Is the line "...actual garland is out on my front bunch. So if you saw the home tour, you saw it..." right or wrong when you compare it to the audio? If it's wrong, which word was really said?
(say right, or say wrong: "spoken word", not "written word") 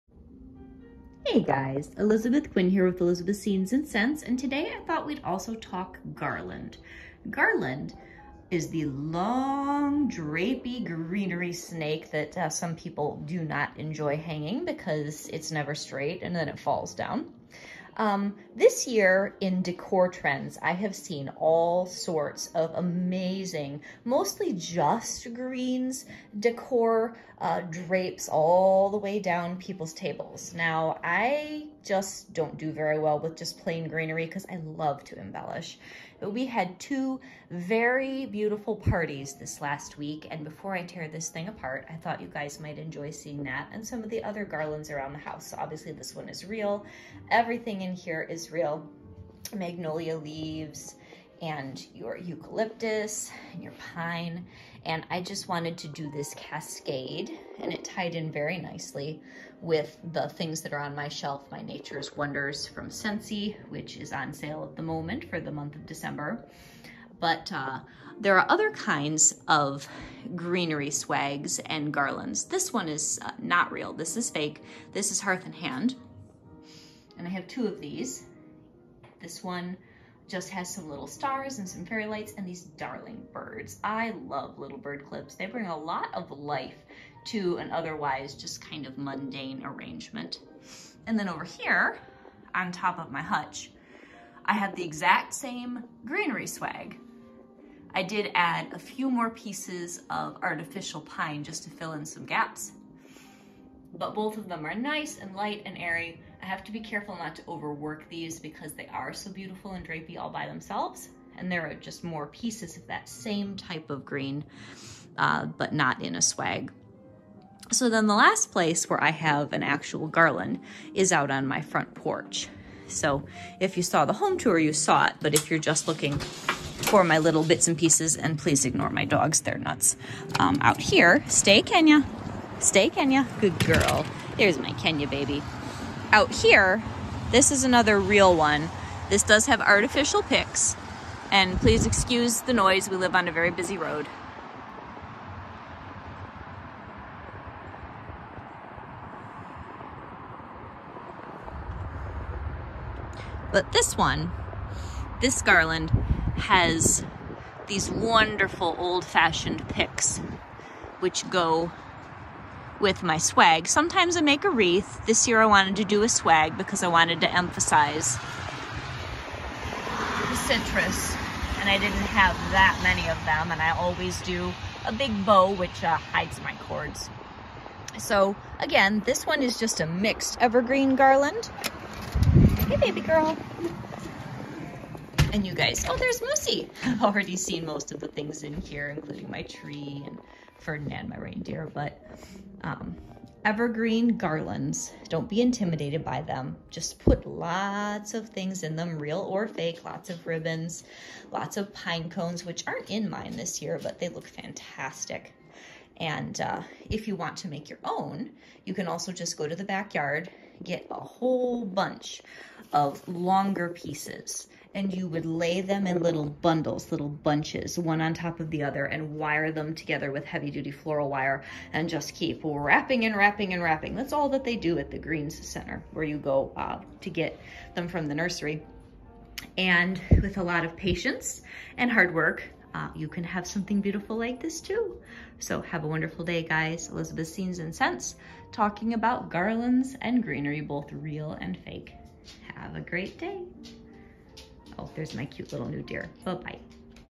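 wrong: "porch", not "bunch".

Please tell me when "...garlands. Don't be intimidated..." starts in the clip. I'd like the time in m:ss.
3:14.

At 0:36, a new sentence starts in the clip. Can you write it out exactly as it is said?
But we had two very beautiful parties this last week.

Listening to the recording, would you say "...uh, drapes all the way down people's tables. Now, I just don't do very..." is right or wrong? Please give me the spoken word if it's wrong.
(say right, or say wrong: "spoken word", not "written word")
right.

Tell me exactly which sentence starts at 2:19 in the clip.
This does have artificial picks, and please excuse the noise, we live on a very busy road.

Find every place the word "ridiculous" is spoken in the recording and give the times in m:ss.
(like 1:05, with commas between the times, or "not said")
not said.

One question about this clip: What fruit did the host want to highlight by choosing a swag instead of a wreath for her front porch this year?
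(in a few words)
Citrus.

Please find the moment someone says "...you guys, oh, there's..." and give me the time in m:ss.
3:05.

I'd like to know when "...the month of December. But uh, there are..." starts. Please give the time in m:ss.
1:05.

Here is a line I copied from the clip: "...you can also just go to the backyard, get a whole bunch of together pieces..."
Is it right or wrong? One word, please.
wrong.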